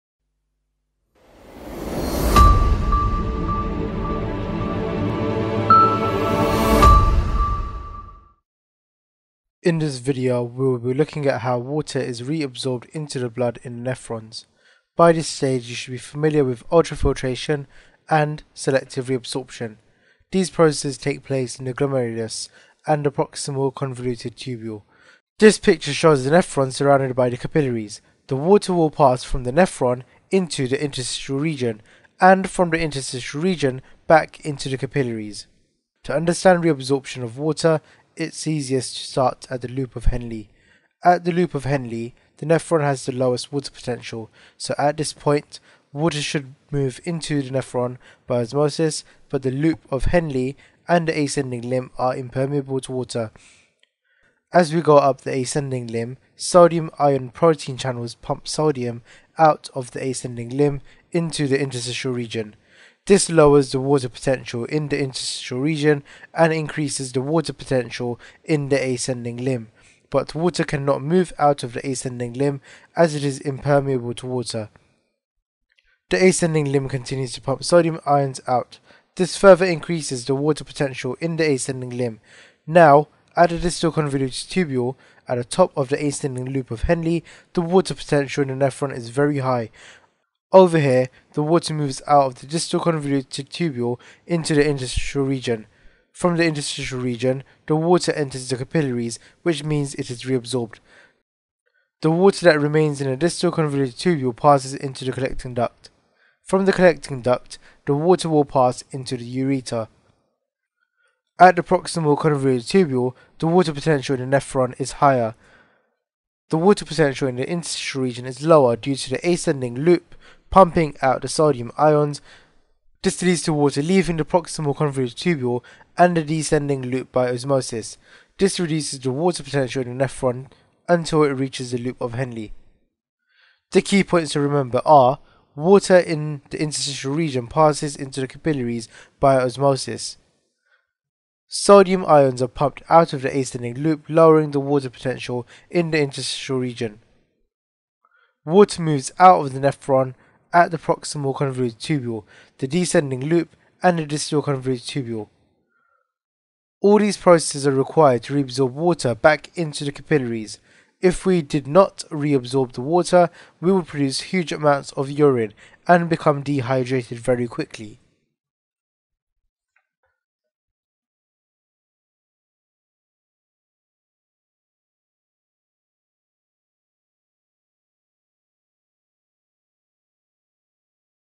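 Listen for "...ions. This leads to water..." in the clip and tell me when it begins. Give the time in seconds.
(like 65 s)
121 s.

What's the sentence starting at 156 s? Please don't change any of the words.
All these processes are required to reabsorb water back into the capillaries.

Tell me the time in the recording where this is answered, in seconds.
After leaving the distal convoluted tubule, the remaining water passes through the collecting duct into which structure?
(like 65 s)
109 s.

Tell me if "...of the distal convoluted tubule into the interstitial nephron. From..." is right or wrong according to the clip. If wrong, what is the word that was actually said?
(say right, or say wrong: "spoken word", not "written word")
wrong: "region", not "nephron".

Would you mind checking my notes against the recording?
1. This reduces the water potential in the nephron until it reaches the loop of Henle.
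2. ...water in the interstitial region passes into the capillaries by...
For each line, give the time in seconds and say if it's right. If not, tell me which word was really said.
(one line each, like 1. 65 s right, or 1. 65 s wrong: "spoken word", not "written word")
1. 128 s right
2. 135 s right.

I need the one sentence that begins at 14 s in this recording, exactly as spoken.
By this stage, you should be familiar with ultrafiltration and selective reabsorption.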